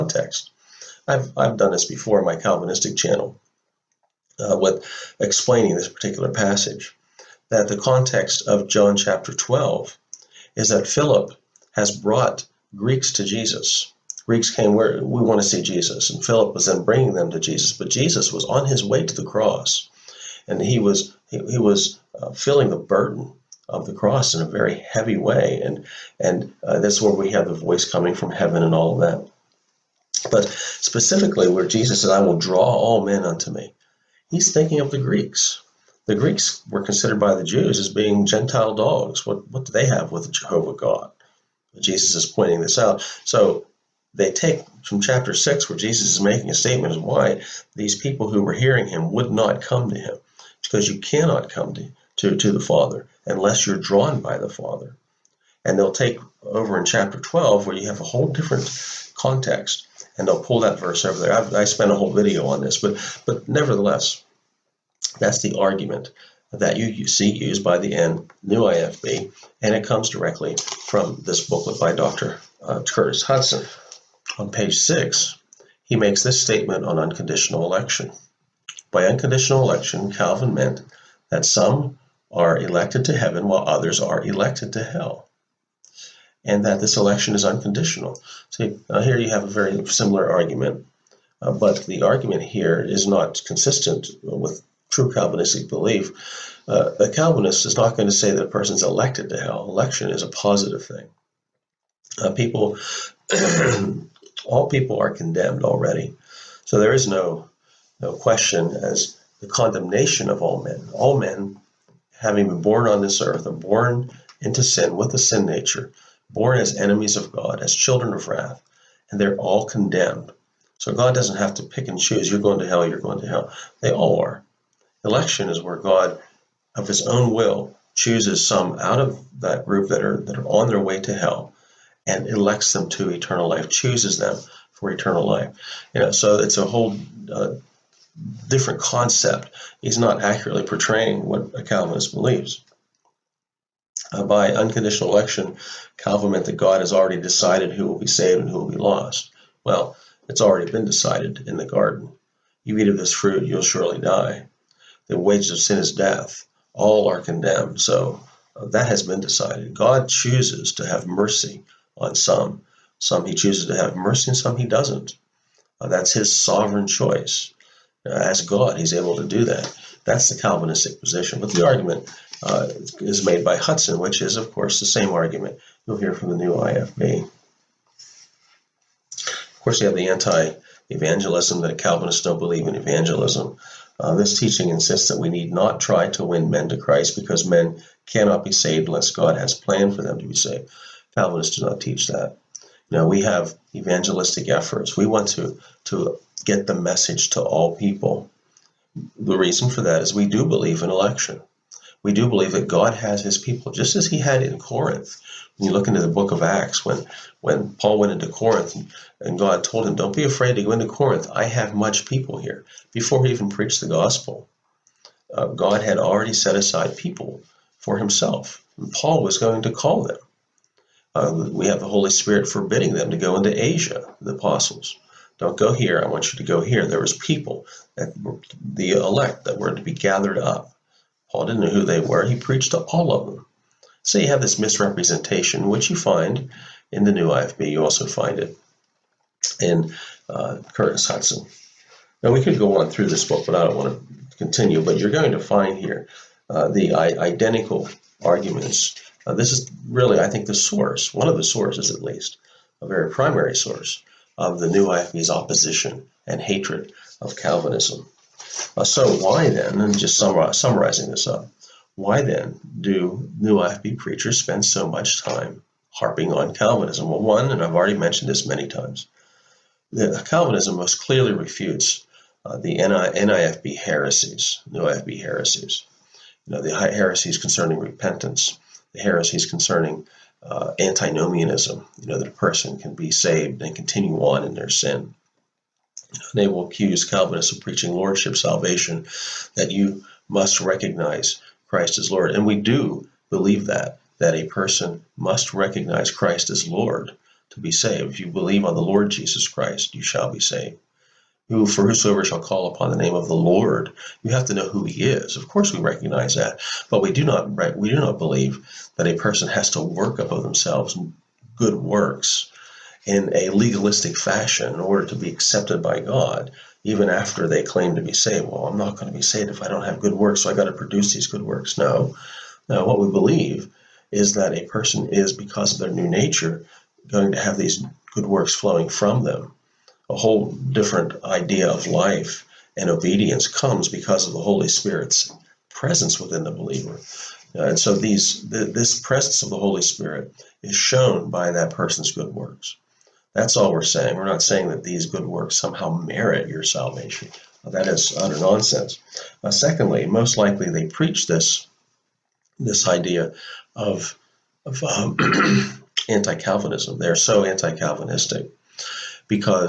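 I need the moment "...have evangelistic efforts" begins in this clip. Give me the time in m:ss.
3:13.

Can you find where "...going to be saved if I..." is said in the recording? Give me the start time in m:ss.
5:18.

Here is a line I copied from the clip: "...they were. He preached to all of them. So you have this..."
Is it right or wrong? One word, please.
right.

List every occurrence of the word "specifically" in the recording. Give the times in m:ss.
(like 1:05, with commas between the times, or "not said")
0:30.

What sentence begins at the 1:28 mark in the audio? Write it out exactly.
See uh, here you have a very similar argument, uh, but the argument here is not consistent with true Calvinistic belief.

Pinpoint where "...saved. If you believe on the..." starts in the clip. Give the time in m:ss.
4:57.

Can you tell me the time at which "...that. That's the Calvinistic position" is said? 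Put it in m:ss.
2:49.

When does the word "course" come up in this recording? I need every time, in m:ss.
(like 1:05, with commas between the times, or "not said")
2:54, 2:59, 5:05.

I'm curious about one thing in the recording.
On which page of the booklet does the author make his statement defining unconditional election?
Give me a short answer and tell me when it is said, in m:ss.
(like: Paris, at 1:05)
6, at 1:14.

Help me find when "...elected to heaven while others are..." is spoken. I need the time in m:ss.
1:22.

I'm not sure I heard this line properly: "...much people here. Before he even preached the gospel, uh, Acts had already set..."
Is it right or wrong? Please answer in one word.
wrong.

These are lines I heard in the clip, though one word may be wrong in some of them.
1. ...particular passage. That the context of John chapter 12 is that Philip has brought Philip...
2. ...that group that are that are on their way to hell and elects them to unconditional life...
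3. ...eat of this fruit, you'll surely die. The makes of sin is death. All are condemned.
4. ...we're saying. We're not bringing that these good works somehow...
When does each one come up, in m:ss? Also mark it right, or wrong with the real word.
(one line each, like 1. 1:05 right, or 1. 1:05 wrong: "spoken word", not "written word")
1. 0:05 wrong: "Greeks", not "Philip"
2. 2:09 wrong: "eternal", not "unconditional"
3. 2:32 wrong: "wages", not "makes"
4. 5:43 wrong: "saying", not "bringing".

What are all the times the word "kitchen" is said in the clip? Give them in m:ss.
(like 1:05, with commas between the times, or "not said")
not said.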